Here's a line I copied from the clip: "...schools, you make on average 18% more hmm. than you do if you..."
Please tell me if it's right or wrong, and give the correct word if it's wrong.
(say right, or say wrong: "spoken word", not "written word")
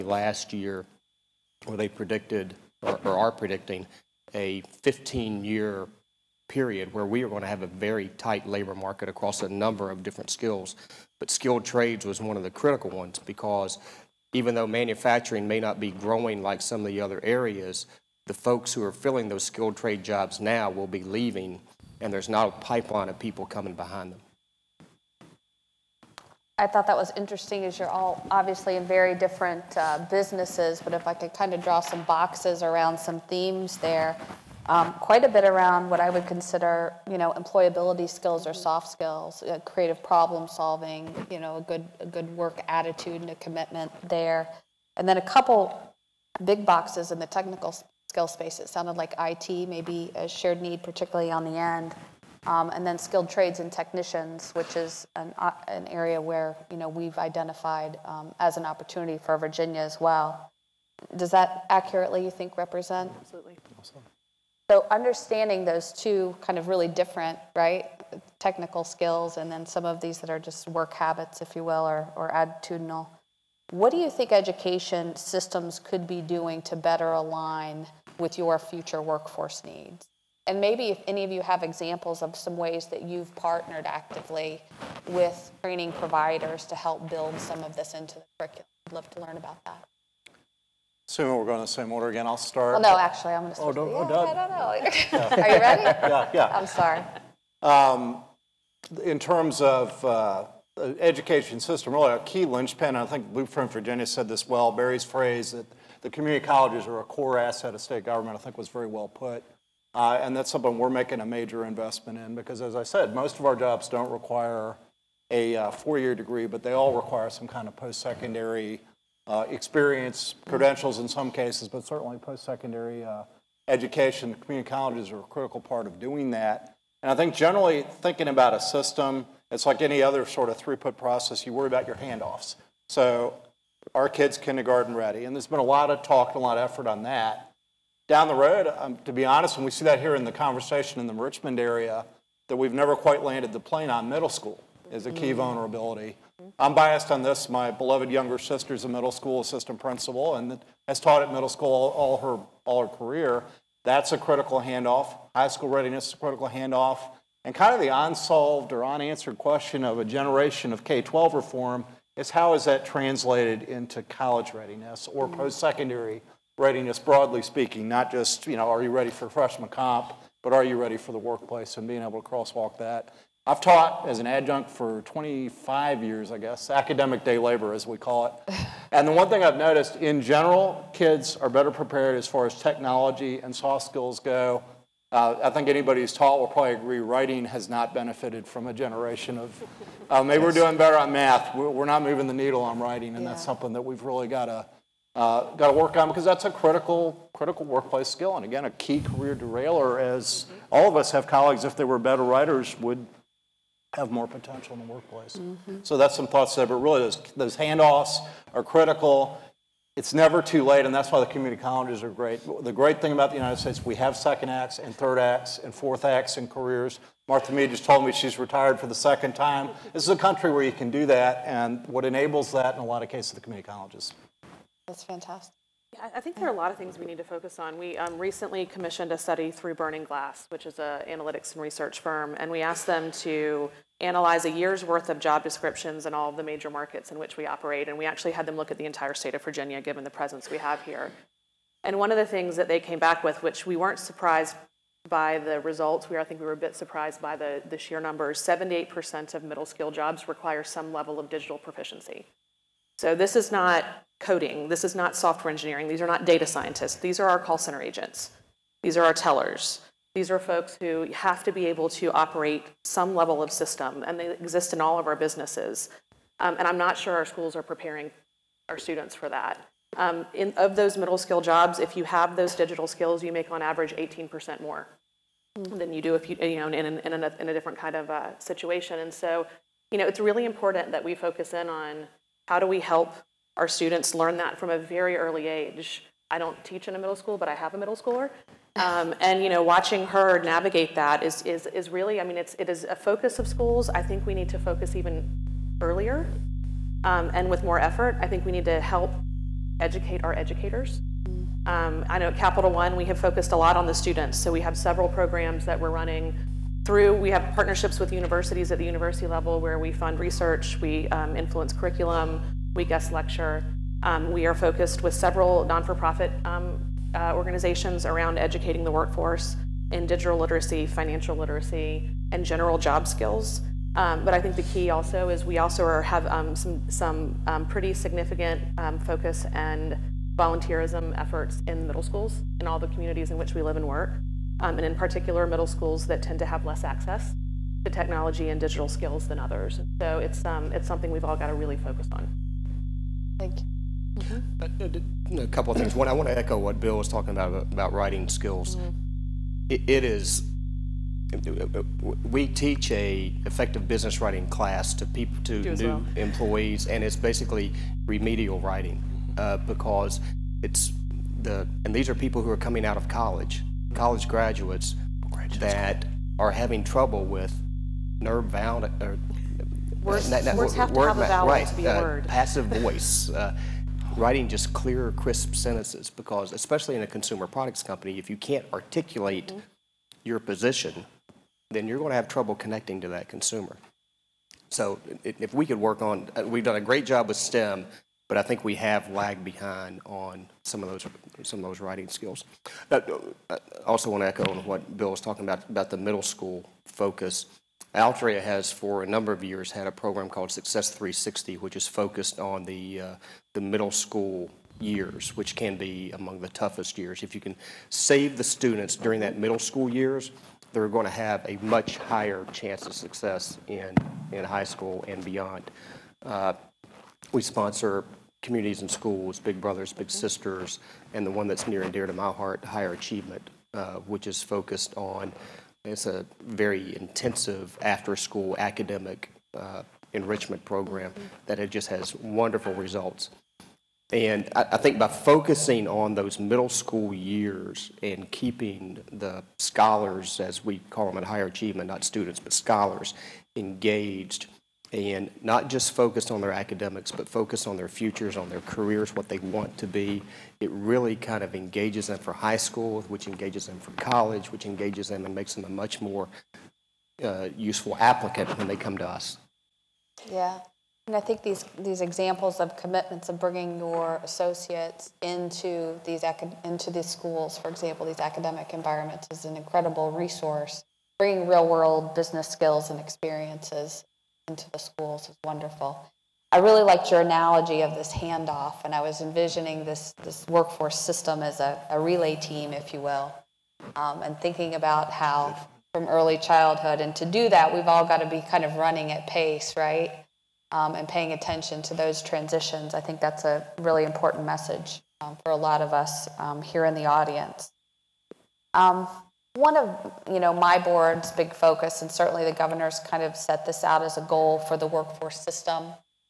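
wrong: "skills", not "schools".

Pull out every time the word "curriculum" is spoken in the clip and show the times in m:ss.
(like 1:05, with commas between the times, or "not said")
1:28, 5:11.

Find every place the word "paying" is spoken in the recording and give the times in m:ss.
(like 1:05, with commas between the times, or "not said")
8:11.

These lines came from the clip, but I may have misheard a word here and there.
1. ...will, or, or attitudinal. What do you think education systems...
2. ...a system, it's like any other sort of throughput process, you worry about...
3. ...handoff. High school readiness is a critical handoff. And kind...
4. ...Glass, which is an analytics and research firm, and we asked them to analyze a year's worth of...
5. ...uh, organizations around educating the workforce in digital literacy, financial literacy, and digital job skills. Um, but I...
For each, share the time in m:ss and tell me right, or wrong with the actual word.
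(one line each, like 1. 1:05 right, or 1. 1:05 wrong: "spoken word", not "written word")
1. 1:11 right
2. 2:08 right
3. 2:34 right
4. 3:50 right
5. 5:17 wrong: "general", not "digital".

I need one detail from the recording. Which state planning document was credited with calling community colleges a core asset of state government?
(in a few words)
Blueprint Virginia.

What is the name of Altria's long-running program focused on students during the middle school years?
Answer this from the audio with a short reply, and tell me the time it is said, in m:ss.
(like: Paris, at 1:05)
Success 360, at 6:40.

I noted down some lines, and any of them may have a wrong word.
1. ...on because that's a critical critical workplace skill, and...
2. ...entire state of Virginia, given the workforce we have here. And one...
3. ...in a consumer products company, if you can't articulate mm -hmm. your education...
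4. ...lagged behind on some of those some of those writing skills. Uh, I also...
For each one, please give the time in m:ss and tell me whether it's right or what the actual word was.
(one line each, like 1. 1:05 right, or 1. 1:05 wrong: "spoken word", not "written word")
1. 3:15 right
2. 3:58 wrong: "presence", not "workforce"
3. 6:16 wrong: "position", not "education"
4. 6:29 right.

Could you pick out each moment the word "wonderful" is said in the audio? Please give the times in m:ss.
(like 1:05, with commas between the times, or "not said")
7:12, 7:55.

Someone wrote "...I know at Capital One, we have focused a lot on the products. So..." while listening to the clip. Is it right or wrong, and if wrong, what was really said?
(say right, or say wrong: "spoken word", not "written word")
wrong: "students", not "products".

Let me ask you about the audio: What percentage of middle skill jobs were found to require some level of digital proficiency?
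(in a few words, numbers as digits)
78%.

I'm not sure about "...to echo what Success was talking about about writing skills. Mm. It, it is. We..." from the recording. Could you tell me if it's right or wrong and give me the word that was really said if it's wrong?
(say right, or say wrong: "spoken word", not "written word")
wrong: "Bill", not "Success".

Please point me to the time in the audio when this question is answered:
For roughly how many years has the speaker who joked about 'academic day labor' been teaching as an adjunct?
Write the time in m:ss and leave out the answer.
2:55.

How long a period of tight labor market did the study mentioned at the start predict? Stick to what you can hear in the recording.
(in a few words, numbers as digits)
15-year.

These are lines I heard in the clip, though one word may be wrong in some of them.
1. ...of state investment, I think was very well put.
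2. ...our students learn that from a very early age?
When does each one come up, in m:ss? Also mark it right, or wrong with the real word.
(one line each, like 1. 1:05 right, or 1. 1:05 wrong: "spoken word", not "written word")
1. 1:47 wrong: "government", not "investment"
2. 4:43 right.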